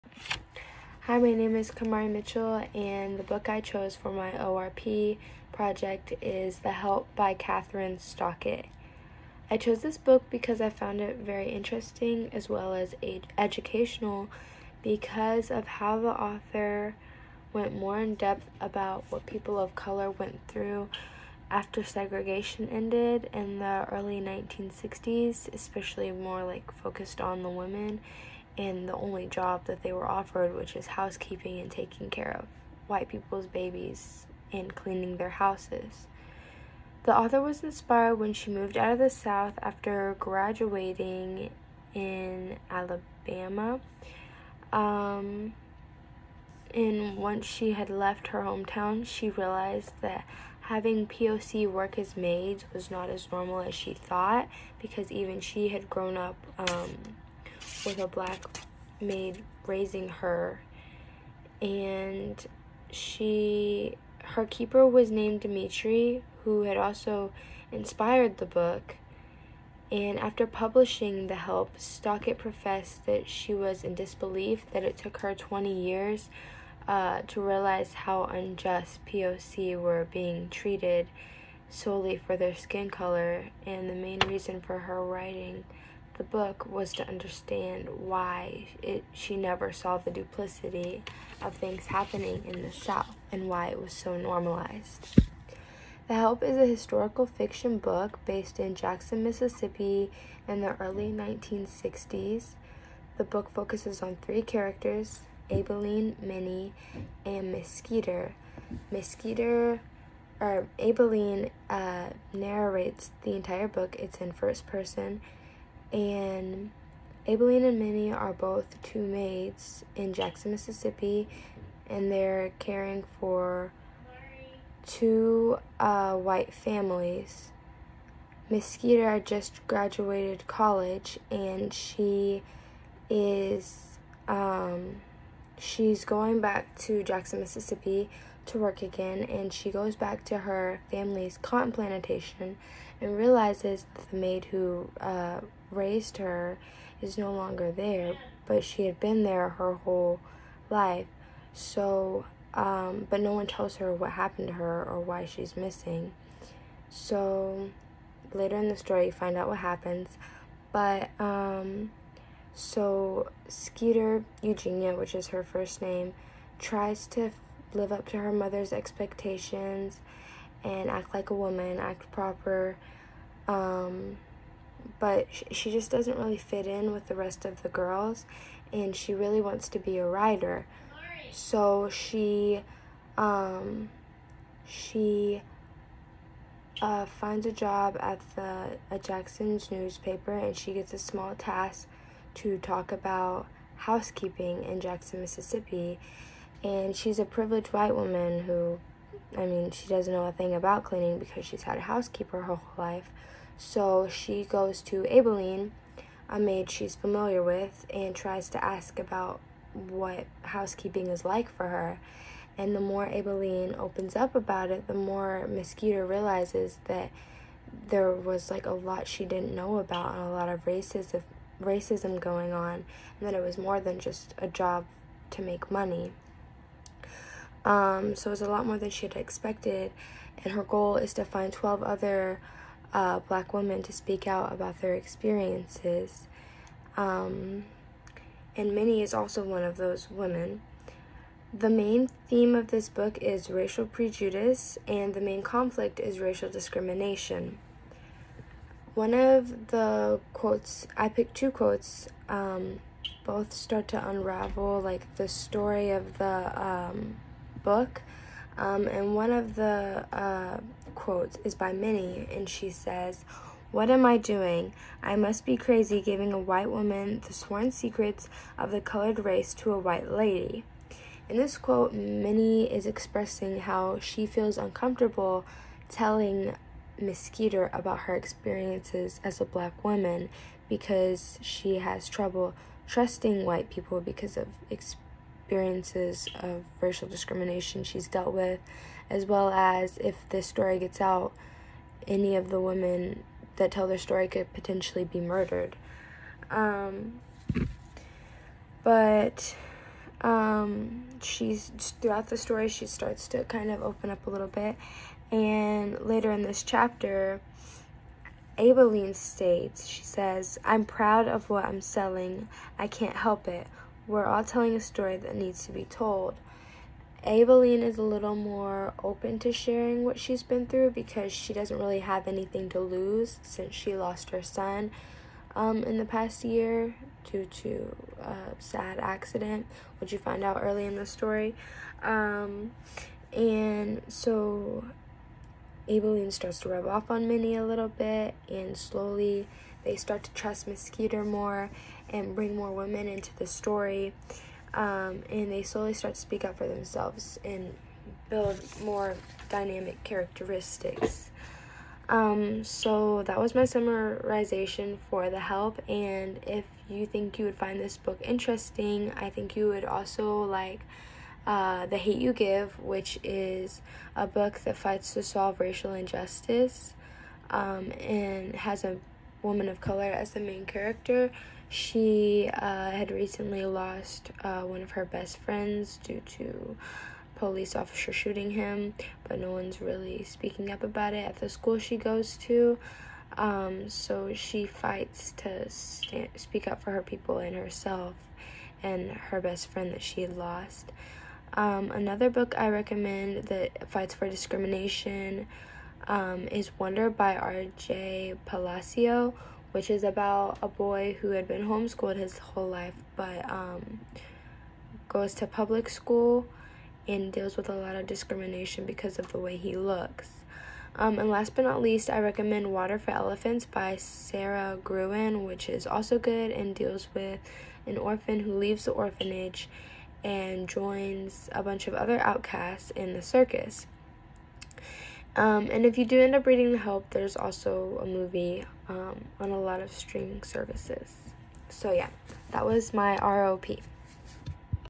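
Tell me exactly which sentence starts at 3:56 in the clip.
Um, and Minny is also one of those women.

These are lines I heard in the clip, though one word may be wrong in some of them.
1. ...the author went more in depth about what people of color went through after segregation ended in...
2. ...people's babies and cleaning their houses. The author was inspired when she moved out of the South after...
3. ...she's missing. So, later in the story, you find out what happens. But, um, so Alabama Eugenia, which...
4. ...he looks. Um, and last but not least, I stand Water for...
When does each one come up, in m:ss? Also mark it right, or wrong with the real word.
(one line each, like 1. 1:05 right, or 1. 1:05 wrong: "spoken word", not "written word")
1. 0:15 right
2. 0:33 right
3. 2:35 wrong: "Skeeter", not "Alabama"
4. 6:49 wrong: "recommend", not "stand".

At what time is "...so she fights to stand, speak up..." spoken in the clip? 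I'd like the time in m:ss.
6:23.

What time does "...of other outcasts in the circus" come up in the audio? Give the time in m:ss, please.
7:01.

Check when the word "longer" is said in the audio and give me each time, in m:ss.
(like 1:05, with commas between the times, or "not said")
2:27.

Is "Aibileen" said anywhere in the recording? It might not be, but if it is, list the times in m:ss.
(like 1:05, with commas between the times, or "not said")
1:45, 1:50, 1:57, 3:25, 3:33, 5:08, 5:17, 5:35.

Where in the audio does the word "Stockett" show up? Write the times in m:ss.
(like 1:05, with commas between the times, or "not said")
0:07, 1:11.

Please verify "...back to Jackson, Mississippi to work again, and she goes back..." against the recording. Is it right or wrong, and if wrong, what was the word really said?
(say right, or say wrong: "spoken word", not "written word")
right.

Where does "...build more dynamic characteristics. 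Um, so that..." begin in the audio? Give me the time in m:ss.
5:48.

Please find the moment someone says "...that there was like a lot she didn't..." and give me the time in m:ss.
3:36.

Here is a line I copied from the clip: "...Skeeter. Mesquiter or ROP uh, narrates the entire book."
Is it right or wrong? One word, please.
wrong.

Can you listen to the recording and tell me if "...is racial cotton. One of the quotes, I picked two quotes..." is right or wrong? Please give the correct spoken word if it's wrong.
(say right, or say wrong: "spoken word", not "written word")
wrong: "discrimination", not "cotton".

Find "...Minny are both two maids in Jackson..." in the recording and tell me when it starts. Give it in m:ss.
1:57.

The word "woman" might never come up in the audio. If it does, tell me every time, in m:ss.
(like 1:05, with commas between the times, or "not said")
2:51, 3:17, 4:26, 4:39, 6:09.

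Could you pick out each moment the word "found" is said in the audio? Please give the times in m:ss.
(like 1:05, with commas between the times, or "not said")
0:10.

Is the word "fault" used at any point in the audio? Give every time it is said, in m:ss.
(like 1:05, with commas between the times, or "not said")
not said.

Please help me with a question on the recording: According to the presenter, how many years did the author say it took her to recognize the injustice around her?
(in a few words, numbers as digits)
20.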